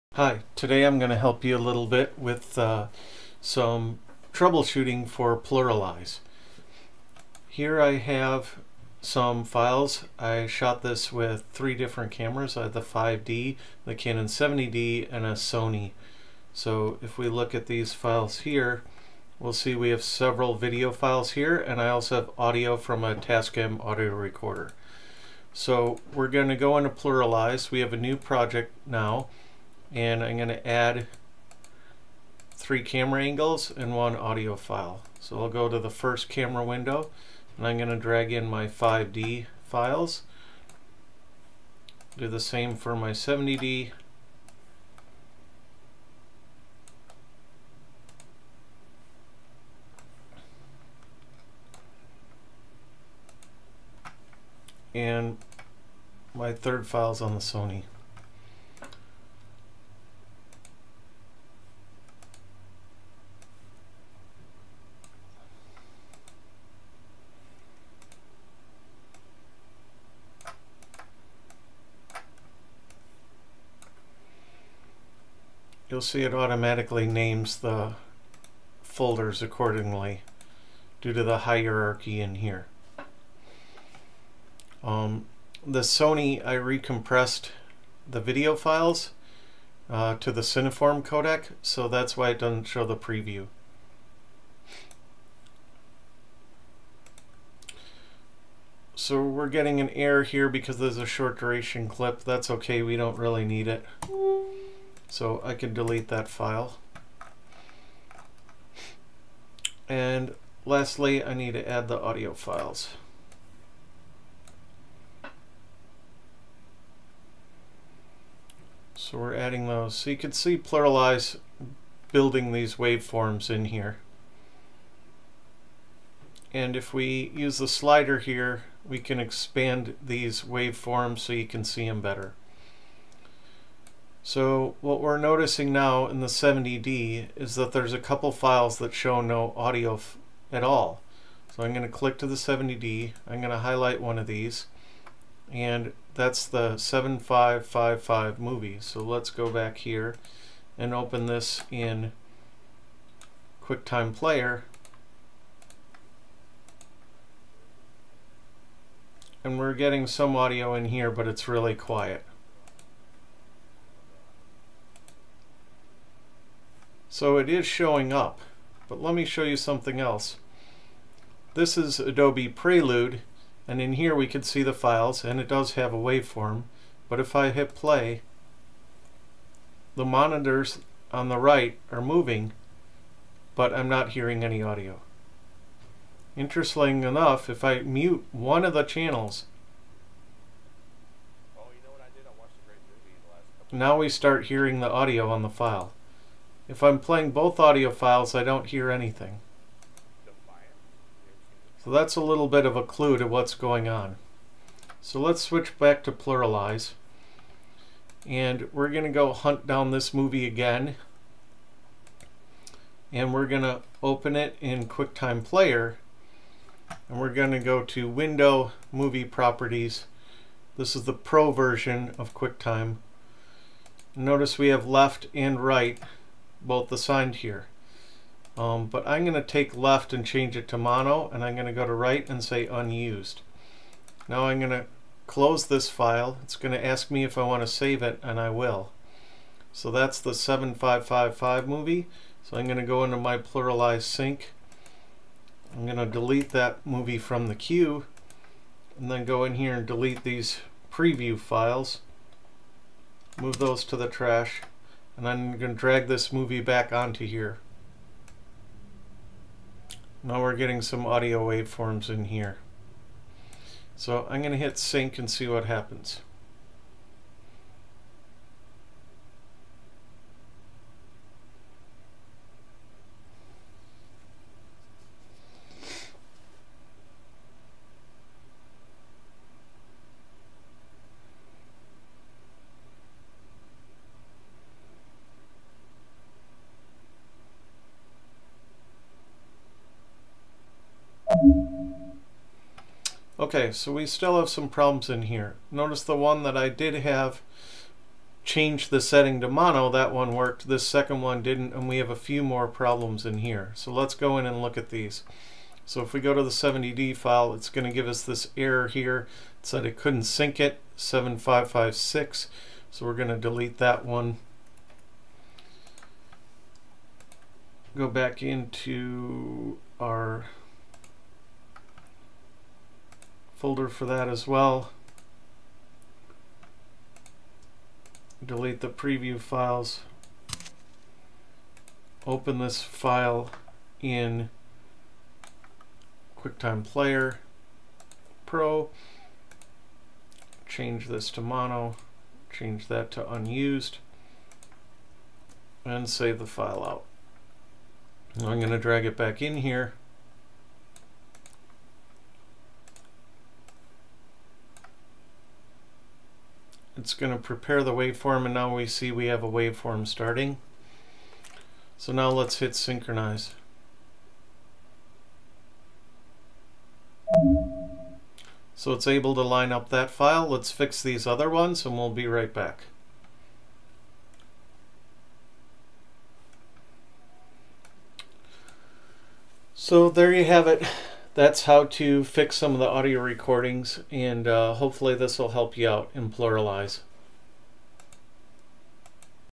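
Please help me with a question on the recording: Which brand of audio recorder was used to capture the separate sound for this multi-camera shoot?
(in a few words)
Tascam.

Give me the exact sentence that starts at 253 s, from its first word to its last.
Move those to the trash and I'm going to drag this movie back onto here.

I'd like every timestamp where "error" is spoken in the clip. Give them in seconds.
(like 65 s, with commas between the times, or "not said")
99 s, 308 s.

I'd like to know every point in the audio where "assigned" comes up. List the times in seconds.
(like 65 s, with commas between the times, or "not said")
226 s.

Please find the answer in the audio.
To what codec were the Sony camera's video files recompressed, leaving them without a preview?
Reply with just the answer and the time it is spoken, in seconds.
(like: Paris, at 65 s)
Cineform, at 90 s.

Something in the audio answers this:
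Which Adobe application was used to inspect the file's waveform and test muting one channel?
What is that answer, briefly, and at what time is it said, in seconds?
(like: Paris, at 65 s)
Adobe Prelude, at 171 s.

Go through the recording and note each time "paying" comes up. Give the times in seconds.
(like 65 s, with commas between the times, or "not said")
not said.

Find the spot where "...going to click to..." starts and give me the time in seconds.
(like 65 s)
141 s.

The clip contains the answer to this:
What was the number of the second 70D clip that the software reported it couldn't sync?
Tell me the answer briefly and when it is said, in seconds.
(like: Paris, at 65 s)
7556, at 310 s.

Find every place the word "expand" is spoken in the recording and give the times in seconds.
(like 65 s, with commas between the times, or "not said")
129 s.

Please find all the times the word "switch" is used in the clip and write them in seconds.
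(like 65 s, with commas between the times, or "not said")
205 s.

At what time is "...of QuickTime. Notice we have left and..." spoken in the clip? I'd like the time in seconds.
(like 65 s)
222 s.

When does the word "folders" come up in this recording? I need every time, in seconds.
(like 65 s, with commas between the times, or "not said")
78 s, 323 s.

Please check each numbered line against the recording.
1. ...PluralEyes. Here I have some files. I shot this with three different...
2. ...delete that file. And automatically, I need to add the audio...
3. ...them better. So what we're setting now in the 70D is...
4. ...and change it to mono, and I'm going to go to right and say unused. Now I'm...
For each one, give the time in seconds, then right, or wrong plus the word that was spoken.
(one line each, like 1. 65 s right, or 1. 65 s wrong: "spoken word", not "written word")
1. 5 s right
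2. 105 s wrong: "lastly", not "automatically"
3. 131 s wrong: "noticing", not "setting"
4. 230 s right.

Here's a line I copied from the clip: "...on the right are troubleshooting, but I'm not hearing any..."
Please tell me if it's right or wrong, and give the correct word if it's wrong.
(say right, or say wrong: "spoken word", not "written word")
wrong: "moving", not "troubleshooting".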